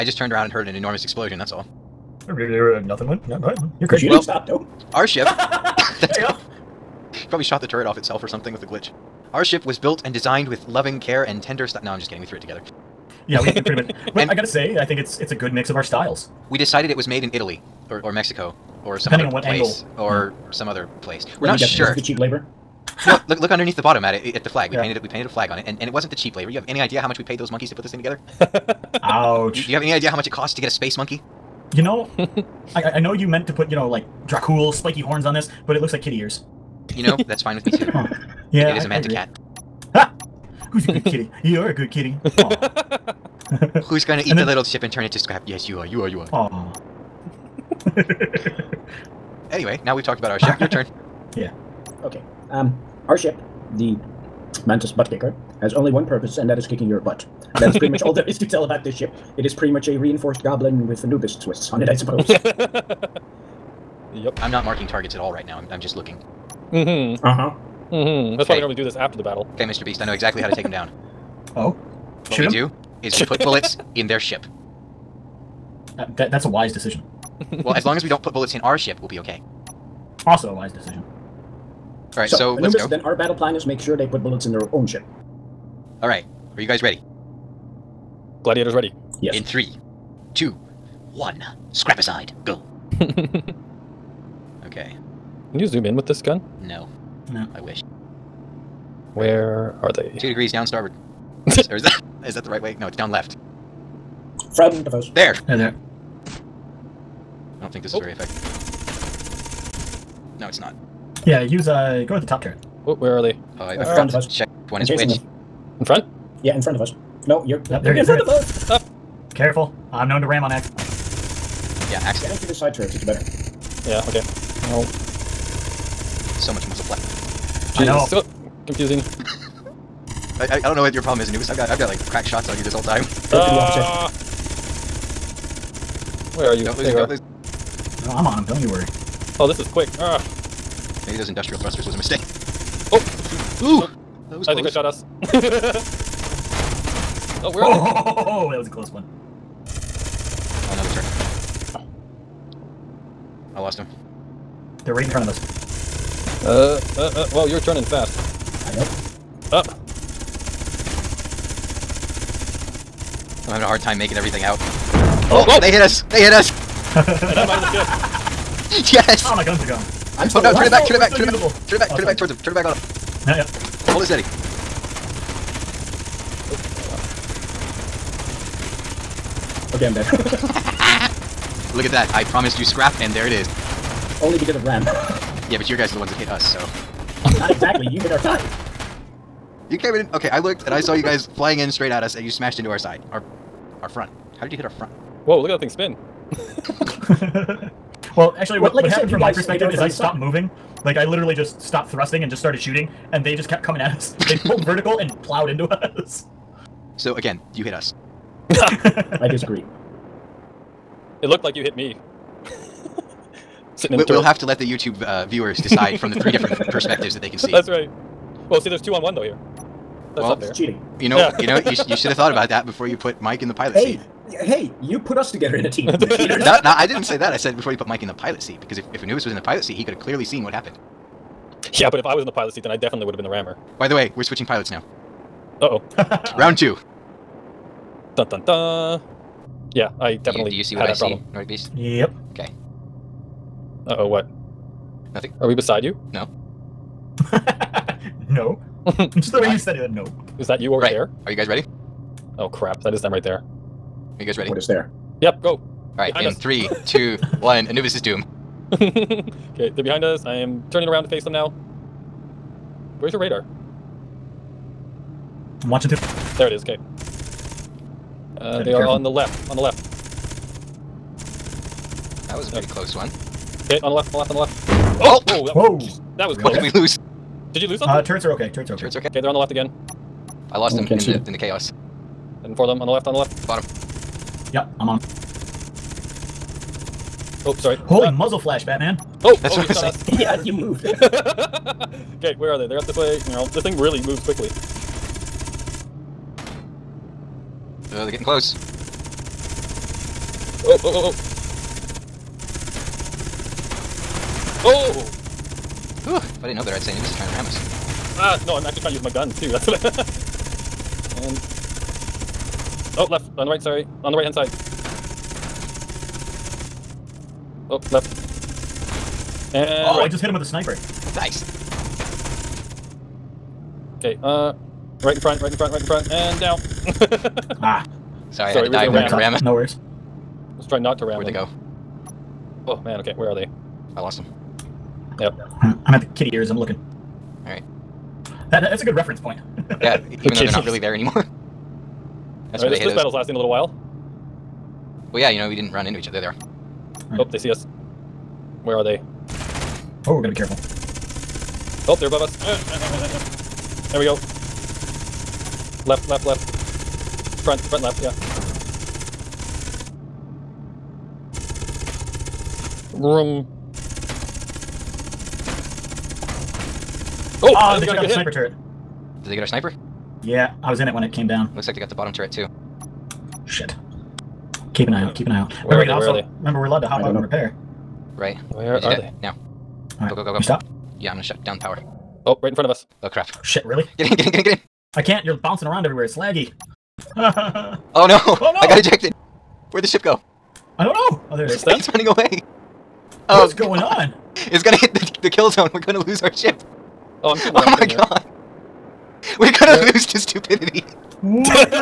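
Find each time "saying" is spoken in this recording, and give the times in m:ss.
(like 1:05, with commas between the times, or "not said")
4:49.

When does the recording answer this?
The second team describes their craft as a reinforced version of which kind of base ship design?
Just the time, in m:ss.
1:00.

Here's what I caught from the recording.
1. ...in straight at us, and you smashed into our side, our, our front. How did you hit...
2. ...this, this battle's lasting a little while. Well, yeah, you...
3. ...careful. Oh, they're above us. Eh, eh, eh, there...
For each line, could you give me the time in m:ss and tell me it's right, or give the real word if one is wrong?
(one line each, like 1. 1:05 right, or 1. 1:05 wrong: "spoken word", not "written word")
1. 3:11 right
2. 5:42 right
3. 5:50 right.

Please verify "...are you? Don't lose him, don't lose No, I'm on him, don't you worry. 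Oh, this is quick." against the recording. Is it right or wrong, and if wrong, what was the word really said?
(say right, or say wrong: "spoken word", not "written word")
right.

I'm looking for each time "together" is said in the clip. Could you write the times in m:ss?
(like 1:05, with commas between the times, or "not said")
0:12, 0:27, 3:45.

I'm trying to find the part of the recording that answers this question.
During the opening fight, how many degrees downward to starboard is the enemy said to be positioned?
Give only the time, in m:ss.
1:40.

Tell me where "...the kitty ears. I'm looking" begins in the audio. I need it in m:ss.
5:35.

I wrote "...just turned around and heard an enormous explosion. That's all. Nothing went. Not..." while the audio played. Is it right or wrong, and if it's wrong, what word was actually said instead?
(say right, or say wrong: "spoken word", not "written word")
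right.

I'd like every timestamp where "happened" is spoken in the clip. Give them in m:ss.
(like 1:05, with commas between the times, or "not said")
3:18, 3:50.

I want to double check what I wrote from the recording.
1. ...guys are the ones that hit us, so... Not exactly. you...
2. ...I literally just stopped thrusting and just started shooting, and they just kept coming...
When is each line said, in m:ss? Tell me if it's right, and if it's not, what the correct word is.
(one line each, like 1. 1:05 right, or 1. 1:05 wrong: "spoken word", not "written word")
1. 3:05 right
2. 3:20 right.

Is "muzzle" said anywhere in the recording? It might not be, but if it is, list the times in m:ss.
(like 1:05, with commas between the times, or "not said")
2:06, 4:48.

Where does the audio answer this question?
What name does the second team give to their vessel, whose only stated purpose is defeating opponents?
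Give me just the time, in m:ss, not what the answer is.
0:54.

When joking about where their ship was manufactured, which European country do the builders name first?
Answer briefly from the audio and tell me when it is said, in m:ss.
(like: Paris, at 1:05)
Italy, at 0:17.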